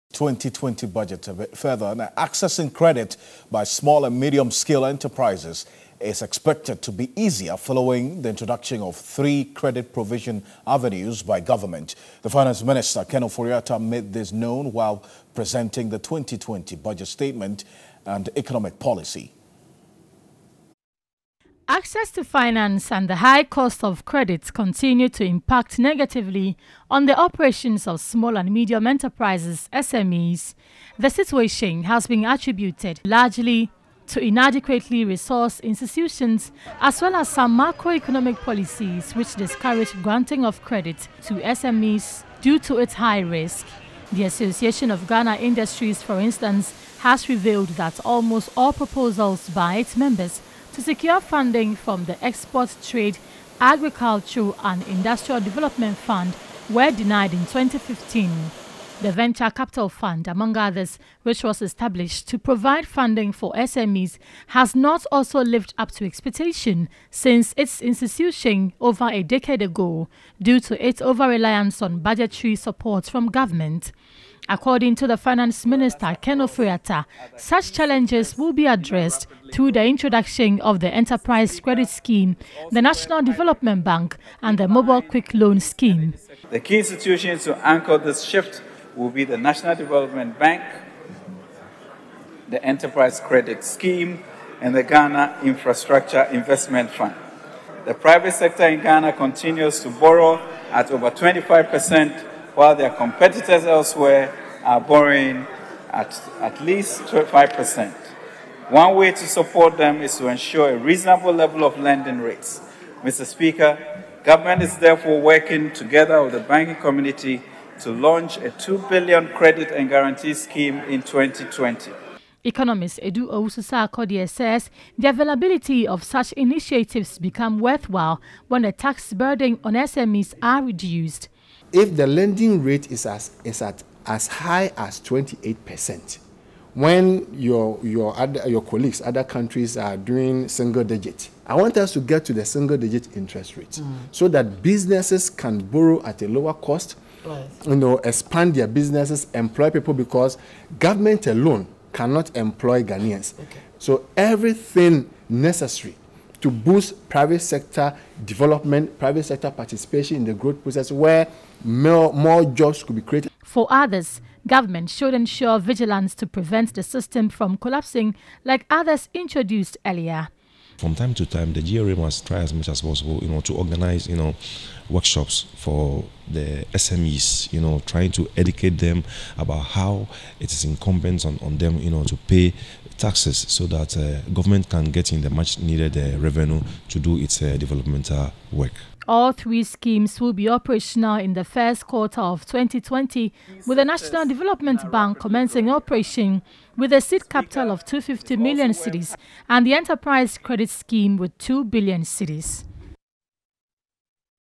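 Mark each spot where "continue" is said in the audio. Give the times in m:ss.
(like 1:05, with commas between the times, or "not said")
0:24, 1:39.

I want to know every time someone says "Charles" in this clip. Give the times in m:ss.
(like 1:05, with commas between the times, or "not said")
not said.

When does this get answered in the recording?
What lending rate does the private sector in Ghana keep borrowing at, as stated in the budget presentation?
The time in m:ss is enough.
1:40.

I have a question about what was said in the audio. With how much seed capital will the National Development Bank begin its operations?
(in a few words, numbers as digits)
250 million cedis.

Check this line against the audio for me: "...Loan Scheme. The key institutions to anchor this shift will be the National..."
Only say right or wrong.
right.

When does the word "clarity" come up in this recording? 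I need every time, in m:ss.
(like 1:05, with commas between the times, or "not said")
not said.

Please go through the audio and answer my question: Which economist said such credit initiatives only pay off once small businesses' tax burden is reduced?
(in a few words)
Edu Oususa Akodie.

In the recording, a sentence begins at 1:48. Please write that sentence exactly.
One way to support them is to ensure a reasonable level of lending rates.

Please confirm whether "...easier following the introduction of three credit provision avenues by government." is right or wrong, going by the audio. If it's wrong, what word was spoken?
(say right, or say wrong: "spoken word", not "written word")
right.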